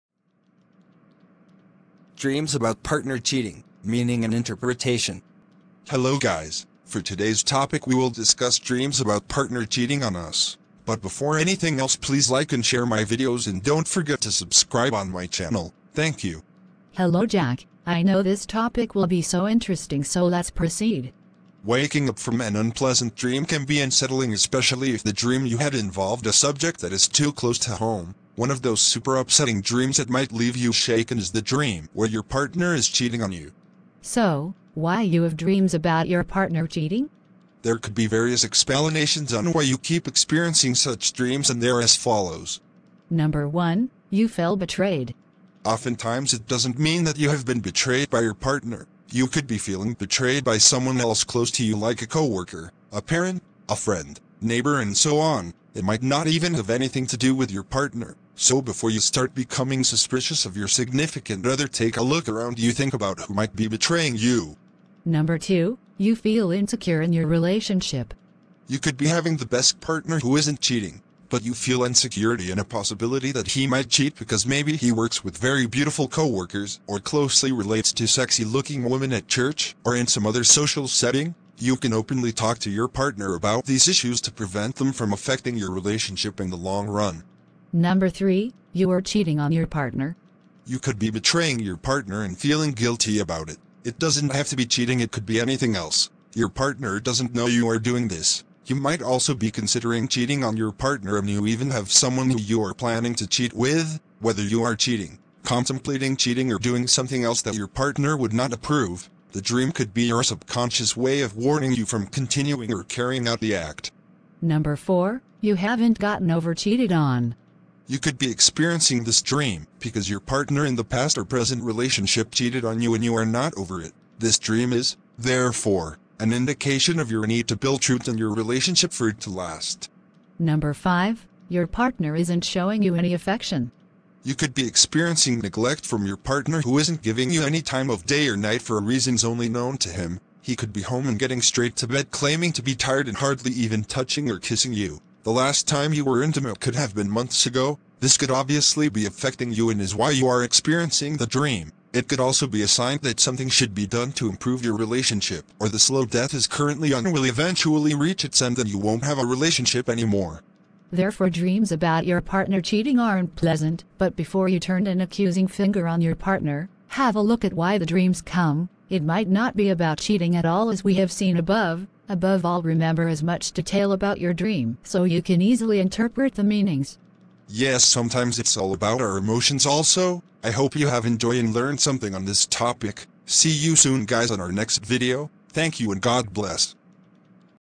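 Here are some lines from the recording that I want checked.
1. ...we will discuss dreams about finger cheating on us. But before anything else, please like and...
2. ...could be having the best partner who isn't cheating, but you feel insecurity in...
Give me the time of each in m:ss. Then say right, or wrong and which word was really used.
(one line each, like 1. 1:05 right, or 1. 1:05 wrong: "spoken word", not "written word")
1. 0:07 wrong: "partner", not "finger"
2. 1:08 right.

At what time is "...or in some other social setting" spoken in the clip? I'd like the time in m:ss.
1:19.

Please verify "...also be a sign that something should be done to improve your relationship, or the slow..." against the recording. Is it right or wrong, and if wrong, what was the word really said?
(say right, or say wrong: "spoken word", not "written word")
right.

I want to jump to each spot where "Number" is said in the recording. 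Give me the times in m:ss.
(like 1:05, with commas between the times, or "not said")
0:43, 1:05, 1:27, 1:54, 2:10.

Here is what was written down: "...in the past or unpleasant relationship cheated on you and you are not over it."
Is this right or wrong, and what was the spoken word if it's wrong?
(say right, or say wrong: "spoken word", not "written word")
wrong: "present", not "unpleasant".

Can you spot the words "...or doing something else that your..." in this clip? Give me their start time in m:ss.
1:46.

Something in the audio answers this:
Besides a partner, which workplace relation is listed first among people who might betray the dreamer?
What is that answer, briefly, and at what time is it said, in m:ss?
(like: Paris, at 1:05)
a coworker, at 0:52.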